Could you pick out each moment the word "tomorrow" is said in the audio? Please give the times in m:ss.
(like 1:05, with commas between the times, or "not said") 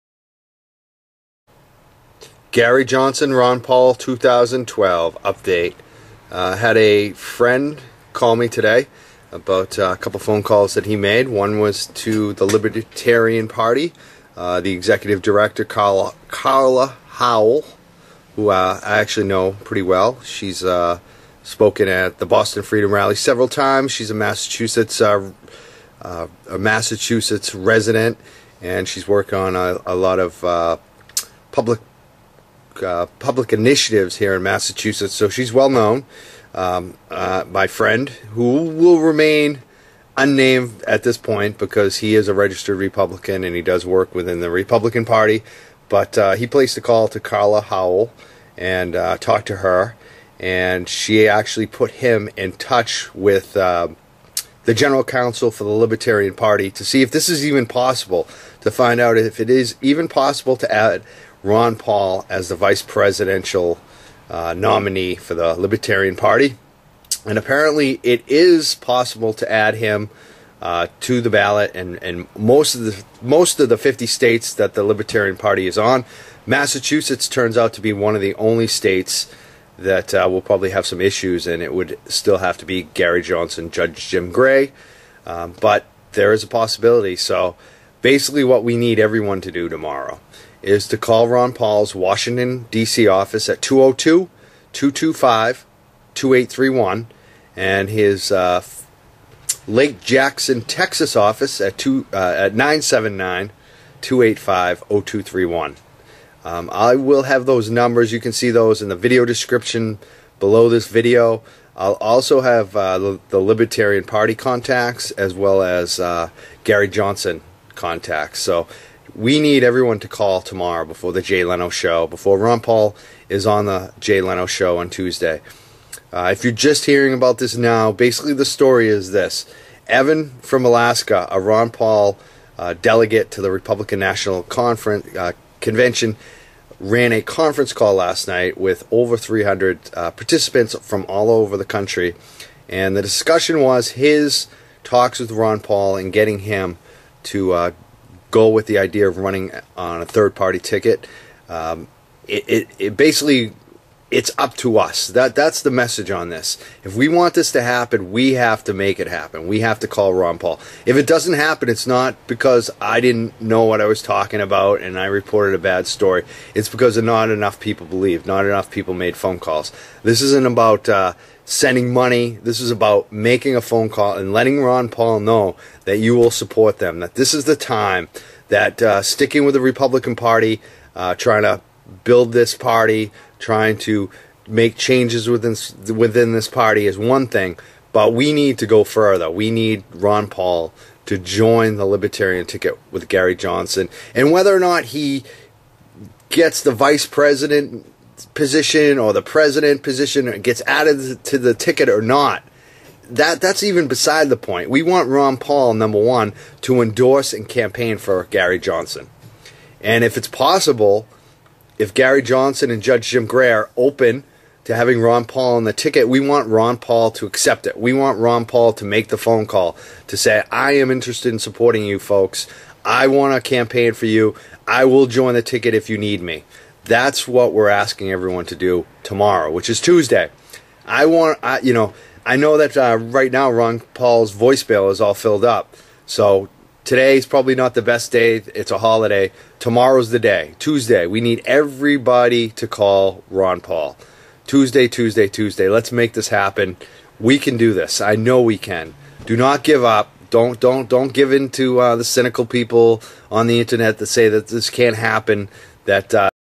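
1:29, 2:00, 3:49, 3:59.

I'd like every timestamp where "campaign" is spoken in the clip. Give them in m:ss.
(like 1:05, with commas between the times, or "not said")
3:27, 3:43.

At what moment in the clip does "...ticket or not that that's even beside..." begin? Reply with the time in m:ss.
3:21.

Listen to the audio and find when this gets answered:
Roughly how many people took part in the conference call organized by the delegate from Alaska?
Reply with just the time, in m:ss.
2:18.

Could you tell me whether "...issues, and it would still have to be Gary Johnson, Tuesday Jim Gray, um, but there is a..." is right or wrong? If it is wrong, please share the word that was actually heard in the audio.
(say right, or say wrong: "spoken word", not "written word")
wrong: "Judge", not "Tuesday".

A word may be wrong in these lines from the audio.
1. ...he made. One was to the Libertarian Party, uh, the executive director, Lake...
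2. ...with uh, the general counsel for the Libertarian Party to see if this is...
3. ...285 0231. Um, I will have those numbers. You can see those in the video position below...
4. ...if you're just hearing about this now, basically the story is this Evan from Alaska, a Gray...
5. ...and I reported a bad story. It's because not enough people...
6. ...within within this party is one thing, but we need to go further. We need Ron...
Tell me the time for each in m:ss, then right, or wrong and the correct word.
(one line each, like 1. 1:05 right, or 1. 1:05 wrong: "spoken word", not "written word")
1. 0:10 wrong: "Carla", not "Lake"
2. 0:53 right
3. 1:44 wrong: "description", not "position"
4. 2:06 wrong: "Ron", not "Gray"
5. 2:44 right
6. 3:05 right.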